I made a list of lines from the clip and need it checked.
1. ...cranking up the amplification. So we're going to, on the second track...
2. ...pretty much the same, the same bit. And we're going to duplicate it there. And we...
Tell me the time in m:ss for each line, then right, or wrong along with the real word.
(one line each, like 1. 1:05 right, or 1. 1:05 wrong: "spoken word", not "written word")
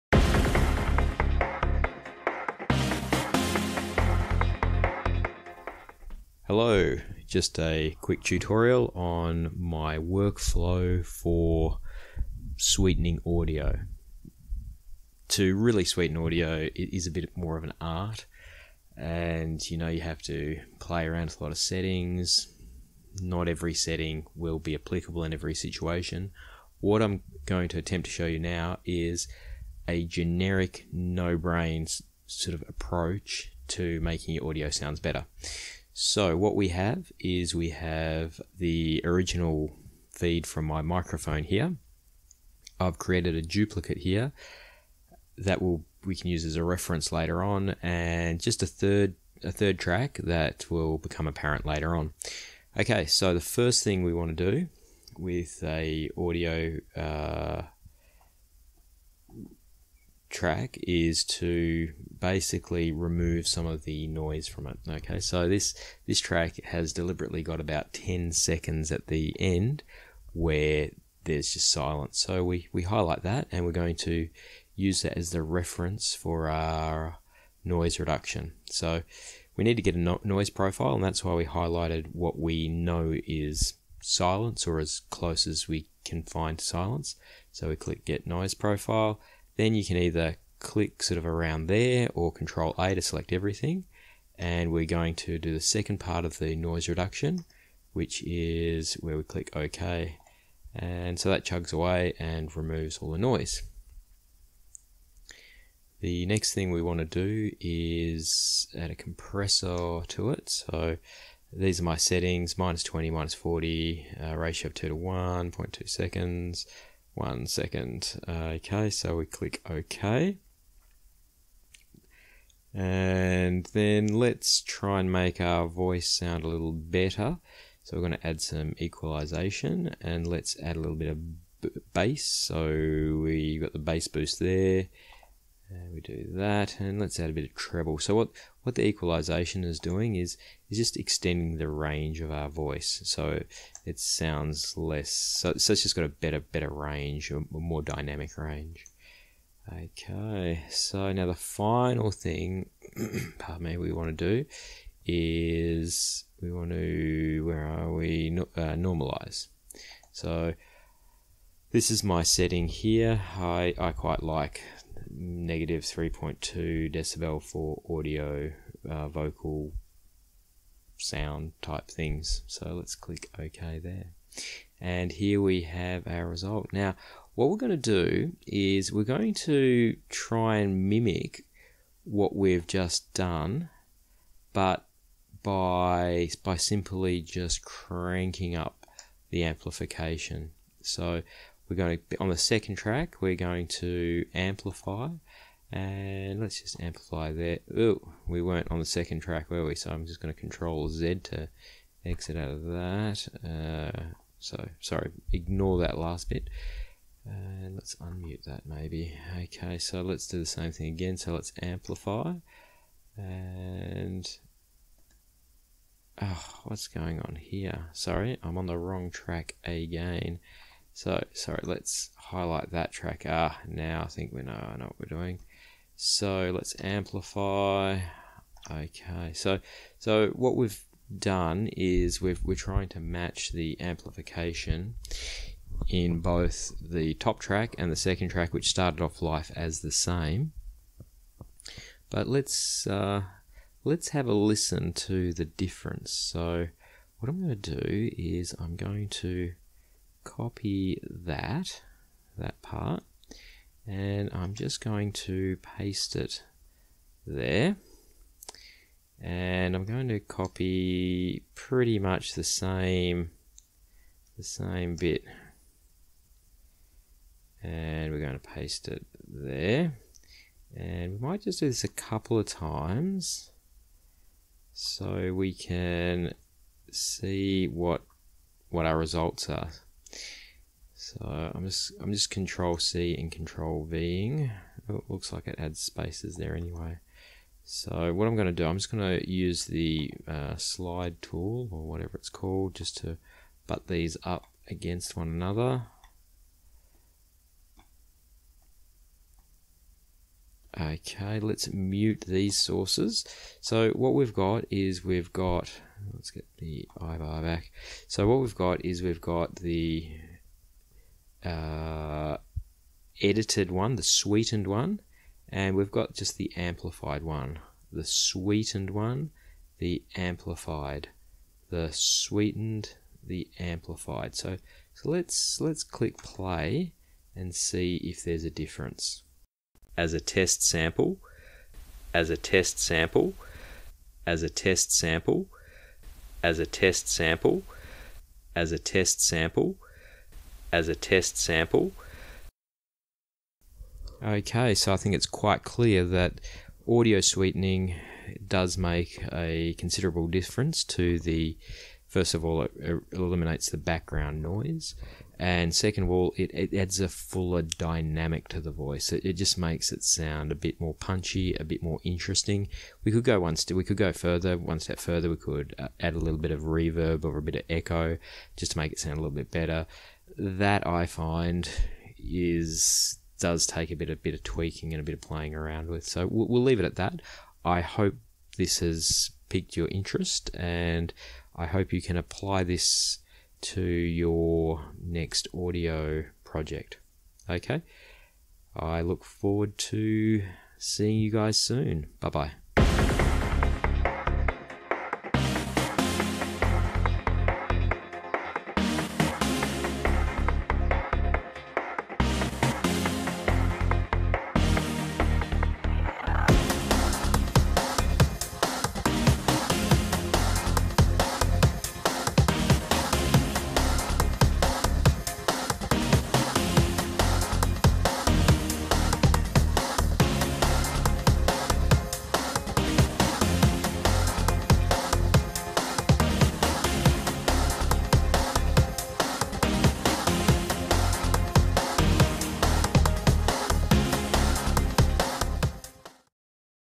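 1. 3:07 right
2. 4:21 wrong: "paste", not "duplicate".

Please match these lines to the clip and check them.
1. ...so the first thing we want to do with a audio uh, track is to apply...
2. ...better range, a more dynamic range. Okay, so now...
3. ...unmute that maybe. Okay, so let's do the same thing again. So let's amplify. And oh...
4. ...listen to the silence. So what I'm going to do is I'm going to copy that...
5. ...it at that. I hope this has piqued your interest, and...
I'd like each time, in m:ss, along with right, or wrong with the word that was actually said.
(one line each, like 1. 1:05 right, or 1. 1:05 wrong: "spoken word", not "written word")
1. 0:53 wrong: "basically", not "apply"
2. 2:26 right
3. 3:27 right
4. 4:04 wrong: "difference", not "silence"
5. 6:16 right.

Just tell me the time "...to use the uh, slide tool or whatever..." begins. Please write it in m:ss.
4:49.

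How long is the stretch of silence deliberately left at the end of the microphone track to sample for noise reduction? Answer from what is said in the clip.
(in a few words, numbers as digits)
10 seconds.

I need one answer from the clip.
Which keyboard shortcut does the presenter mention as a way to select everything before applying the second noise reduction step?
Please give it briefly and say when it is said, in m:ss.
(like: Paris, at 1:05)
Control A, at 1:32.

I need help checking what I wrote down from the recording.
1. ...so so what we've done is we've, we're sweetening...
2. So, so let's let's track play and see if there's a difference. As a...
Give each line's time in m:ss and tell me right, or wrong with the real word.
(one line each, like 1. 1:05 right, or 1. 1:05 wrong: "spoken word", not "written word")
1. 3:49 wrong: "trying", not "sweetening"
2. 5:24 wrong: "click", not "track".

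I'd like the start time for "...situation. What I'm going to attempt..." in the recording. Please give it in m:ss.
0:25.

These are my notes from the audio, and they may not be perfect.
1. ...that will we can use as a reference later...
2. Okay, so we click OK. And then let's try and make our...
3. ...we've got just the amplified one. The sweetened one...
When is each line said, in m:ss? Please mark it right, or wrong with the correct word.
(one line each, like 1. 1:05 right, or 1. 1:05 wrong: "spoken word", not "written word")
1. 0:45 right
2. 1:58 right
3. 5:15 right.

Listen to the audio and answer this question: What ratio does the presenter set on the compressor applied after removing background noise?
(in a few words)
2 to 1.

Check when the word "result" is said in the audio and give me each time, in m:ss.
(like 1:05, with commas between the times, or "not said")
2:56, 4:38.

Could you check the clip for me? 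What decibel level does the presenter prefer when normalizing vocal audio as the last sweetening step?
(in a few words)
-3.2 decibels.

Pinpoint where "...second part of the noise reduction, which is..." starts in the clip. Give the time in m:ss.
1:35.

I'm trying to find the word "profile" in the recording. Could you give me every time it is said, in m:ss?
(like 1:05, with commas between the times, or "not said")
1:20, 1:28.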